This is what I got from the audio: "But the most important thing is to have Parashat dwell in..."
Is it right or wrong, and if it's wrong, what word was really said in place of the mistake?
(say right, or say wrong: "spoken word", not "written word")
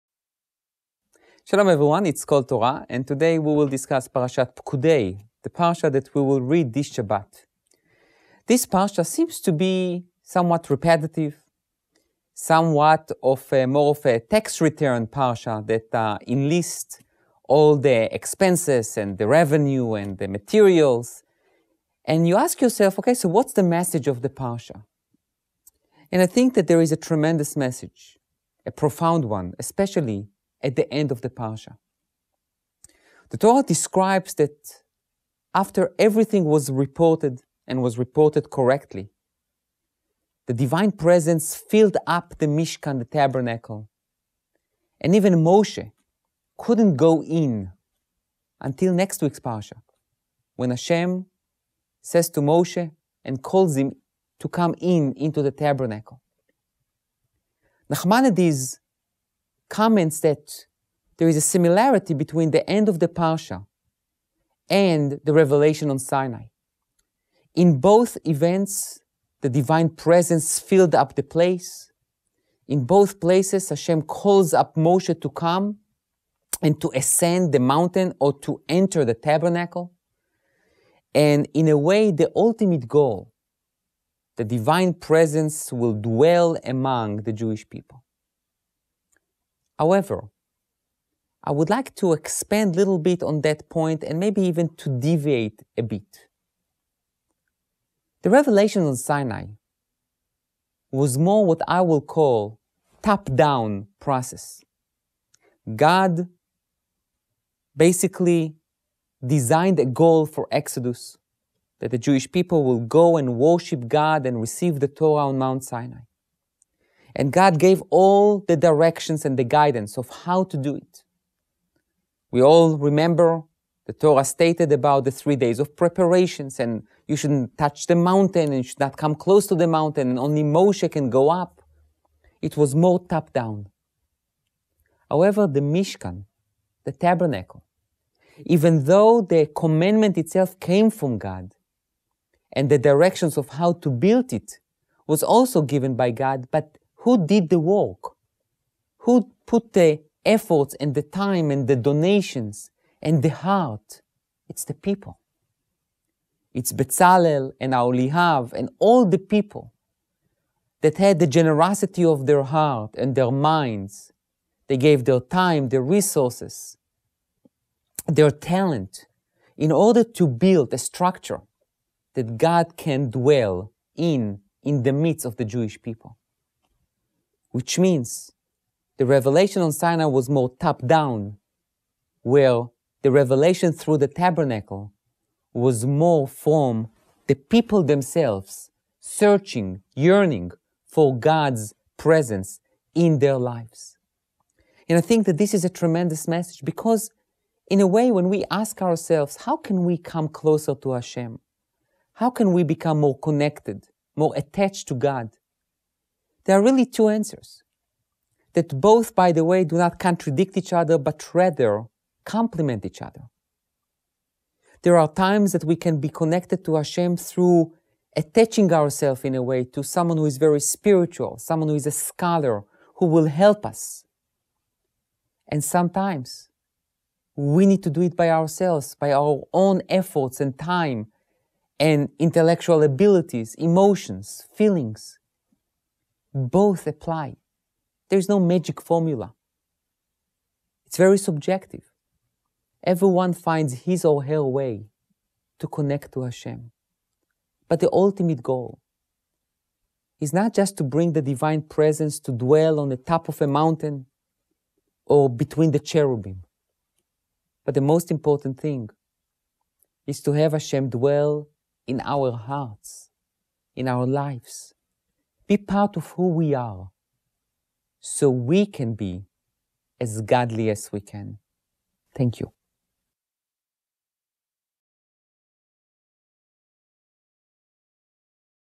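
wrong: "Hashem", not "Parashat".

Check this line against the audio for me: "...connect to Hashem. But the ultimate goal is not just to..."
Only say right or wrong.
right.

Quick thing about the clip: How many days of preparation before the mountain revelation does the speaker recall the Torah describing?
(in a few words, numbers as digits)
3.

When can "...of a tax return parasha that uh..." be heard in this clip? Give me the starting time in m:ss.
0:13.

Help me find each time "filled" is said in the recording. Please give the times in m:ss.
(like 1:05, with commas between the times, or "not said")
0:41, 1:10.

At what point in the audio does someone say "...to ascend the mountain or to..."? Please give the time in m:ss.
1:16.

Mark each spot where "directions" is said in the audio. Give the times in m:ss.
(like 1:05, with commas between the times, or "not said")
1:58, 2:22.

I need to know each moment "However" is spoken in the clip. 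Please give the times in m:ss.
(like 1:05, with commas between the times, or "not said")
1:29, 2:15.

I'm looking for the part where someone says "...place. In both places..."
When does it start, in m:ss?
1:11.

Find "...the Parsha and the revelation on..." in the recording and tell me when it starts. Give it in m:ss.
1:02.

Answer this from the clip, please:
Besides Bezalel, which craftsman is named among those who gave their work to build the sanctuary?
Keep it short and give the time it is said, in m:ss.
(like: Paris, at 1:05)
Oholiav, at 2:37.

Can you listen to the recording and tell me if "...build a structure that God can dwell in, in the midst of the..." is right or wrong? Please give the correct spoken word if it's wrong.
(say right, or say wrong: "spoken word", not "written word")
right.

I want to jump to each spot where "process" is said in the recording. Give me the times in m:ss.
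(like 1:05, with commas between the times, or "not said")
1:43.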